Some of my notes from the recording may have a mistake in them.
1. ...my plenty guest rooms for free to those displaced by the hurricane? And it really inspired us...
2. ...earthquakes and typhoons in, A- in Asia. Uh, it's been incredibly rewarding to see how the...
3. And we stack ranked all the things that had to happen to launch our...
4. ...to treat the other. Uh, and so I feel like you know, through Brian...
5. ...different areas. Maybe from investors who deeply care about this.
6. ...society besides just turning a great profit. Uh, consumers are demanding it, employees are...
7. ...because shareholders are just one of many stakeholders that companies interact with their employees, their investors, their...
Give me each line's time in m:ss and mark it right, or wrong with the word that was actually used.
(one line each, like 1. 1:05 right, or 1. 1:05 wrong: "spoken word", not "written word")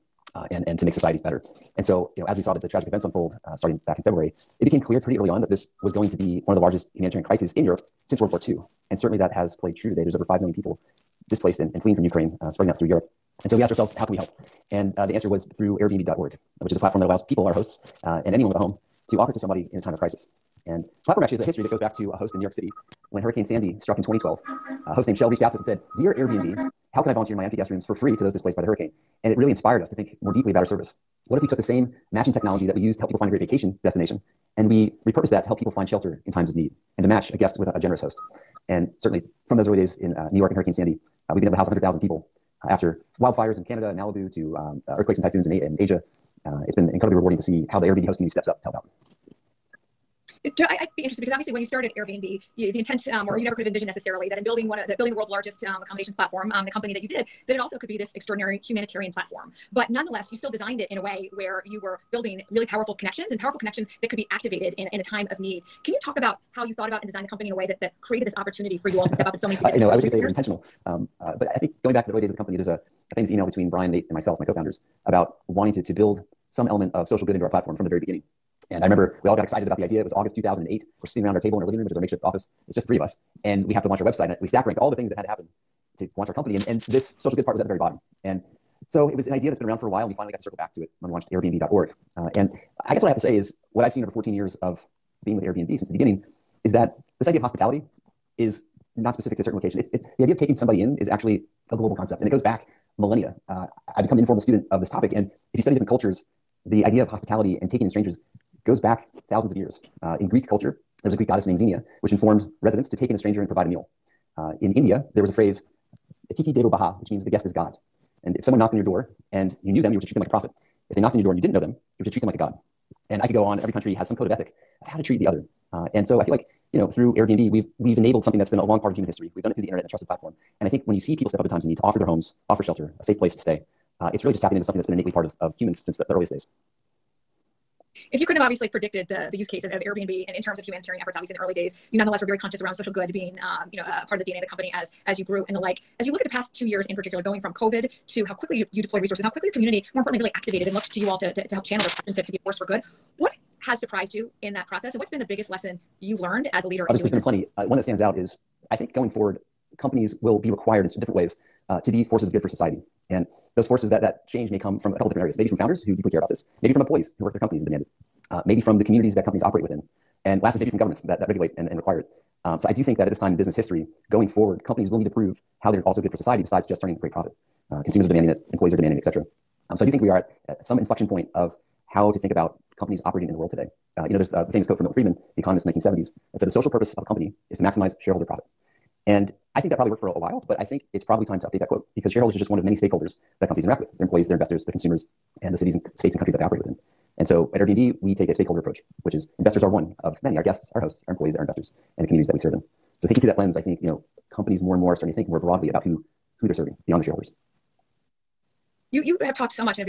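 1. 0:27 wrong: "empty", not "plenty"
2. 0:44 right
3. 1:24 right
4. 2:04 wrong: "Airbnb", not "Brian"
5. 2:45 wrong: "founders", not "investors"
6. 2:56 right
7. 3:11 right.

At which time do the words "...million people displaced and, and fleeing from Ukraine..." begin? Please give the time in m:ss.
0:10.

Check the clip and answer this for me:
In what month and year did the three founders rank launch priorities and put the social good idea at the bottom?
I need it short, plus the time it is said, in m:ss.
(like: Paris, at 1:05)
August 2008, at 1:20.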